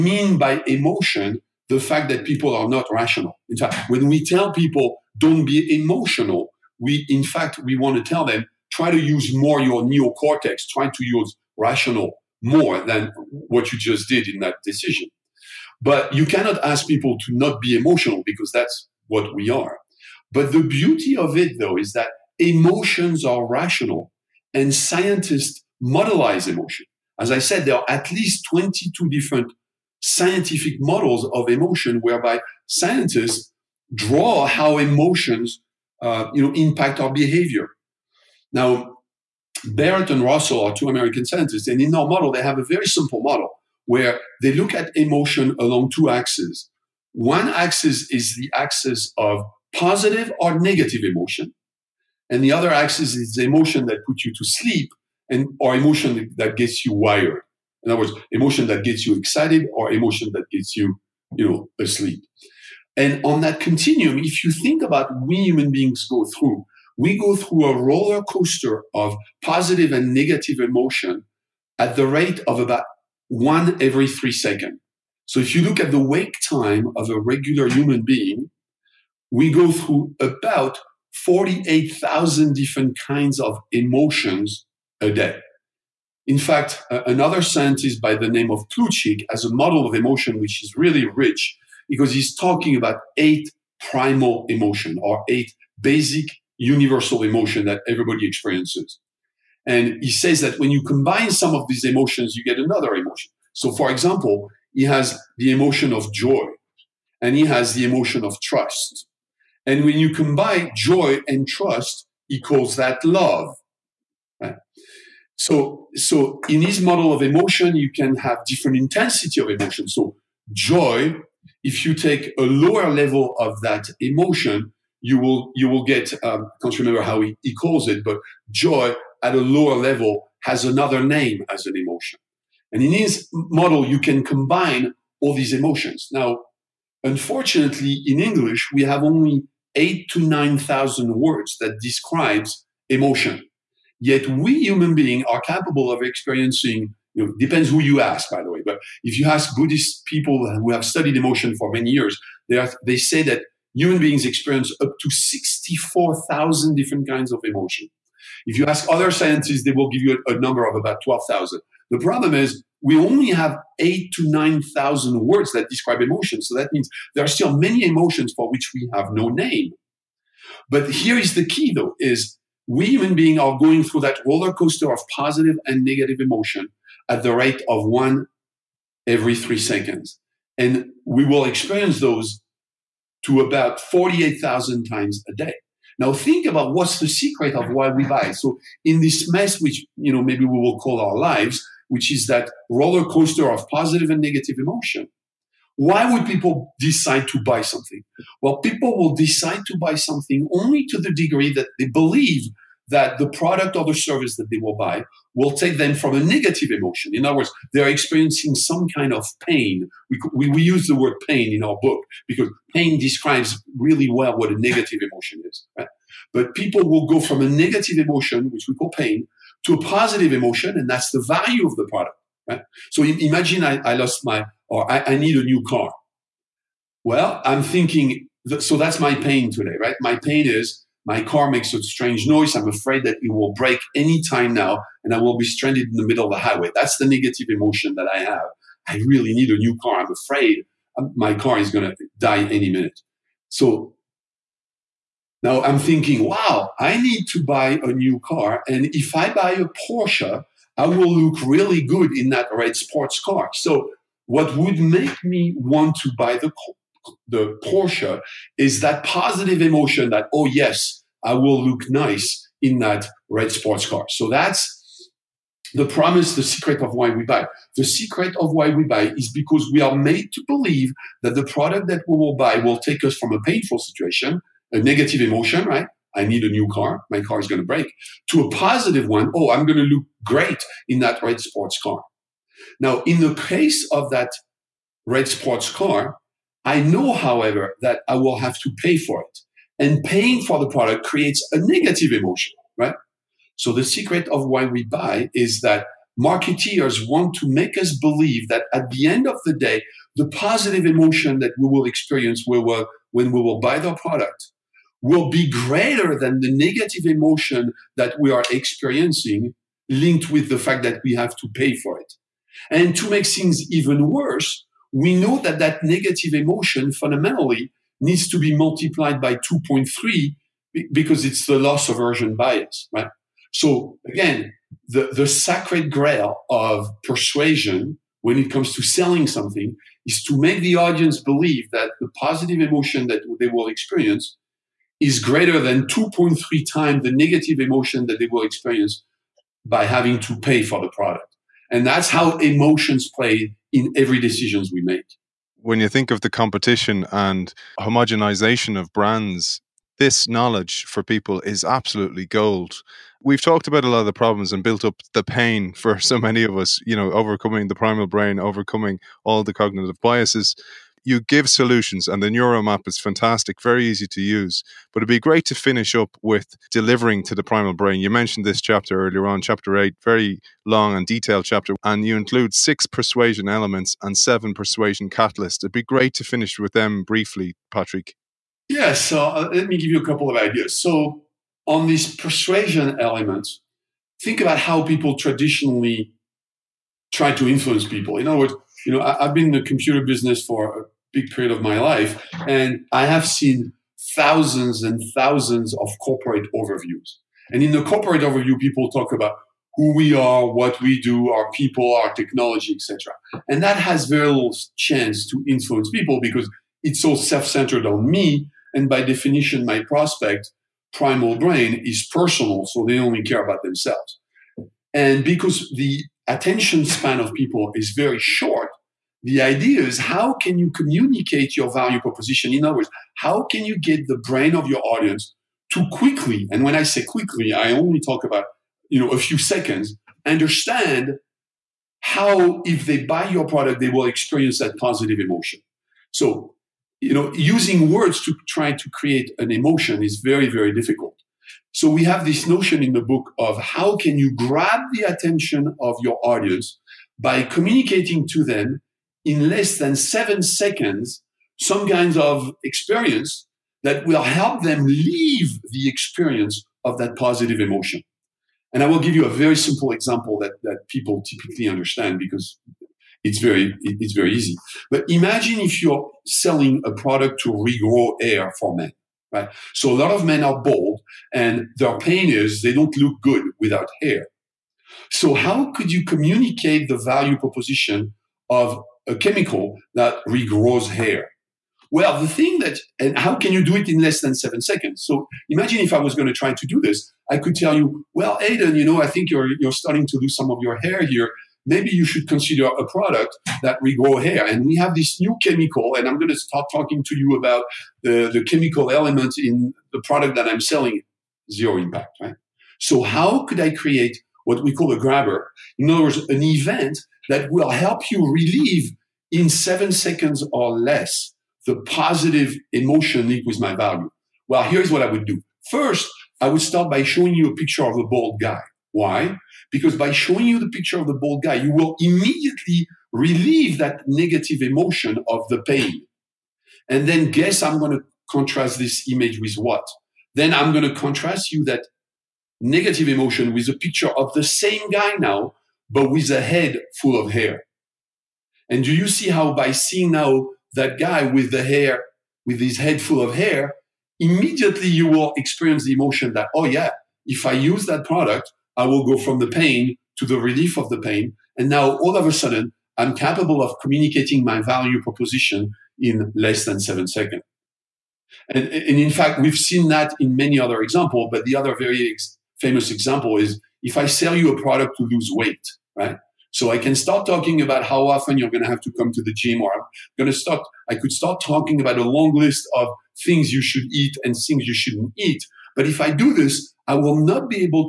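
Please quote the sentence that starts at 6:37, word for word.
And in the corporate overview, people talk about who we are, what we do, our people, our technology, etc.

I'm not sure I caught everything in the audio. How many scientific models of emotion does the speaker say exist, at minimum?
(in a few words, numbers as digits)
22.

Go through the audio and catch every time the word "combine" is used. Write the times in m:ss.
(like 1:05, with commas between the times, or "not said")
1:40, 1:50, 2:14.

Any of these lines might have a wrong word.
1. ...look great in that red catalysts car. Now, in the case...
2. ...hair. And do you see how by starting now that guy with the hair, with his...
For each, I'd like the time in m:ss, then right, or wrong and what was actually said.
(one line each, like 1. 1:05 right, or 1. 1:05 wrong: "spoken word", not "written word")
1. 4:39 wrong: "sports", not "catalysts"
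2. 8:57 wrong: "seeing", not "starting".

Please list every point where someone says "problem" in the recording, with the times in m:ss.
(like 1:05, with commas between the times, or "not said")
2:41, 5:54.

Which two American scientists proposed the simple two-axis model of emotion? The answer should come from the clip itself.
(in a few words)
Barrett and Russell.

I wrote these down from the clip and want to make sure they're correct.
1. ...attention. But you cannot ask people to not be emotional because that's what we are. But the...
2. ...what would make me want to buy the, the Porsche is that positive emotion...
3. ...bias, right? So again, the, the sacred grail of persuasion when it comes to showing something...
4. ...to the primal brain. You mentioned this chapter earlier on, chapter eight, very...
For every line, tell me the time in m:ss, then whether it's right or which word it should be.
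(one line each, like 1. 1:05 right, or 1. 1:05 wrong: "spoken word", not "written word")
1. 0:14 wrong: "decision", not "attention"
2. 4:14 right
3. 5:22 wrong: "selling", not "showing"
4. 6:07 right.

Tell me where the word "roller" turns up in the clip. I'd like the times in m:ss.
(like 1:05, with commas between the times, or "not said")
1:07, 2:54, 3:12.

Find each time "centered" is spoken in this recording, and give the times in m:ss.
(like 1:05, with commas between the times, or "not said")
6:47.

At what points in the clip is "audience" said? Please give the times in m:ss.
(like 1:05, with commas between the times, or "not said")
5:30, 7:04, 7:26.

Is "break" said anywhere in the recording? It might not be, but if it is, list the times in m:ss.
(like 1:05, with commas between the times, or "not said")
3:53, 4:37.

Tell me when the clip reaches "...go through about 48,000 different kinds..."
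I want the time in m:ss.
1:19.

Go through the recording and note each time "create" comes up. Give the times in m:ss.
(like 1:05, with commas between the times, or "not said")
4:51, 7:18, 8:23.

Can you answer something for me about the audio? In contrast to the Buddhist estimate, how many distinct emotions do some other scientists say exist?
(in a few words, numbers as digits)
12,000.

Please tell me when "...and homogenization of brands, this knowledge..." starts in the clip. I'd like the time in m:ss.
5:47.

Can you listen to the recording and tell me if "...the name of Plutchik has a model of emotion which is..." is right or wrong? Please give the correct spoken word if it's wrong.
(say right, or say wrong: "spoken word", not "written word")
right.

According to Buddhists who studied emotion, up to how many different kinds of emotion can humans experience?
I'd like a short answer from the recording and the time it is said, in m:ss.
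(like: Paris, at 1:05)
64,000, at 2:35.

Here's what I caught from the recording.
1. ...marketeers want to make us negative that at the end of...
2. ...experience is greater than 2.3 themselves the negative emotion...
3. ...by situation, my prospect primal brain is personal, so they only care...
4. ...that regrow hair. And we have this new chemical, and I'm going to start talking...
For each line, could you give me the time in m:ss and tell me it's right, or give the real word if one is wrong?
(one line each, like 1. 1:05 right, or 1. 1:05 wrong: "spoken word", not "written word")
1. 4:56 wrong: "believe", not "negative"
2. 5:33 wrong: "times", not "themselves"
3. 6:48 wrong: "definition", not "situation"
4. 8:13 right.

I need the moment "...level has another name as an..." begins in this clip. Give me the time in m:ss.
2:09.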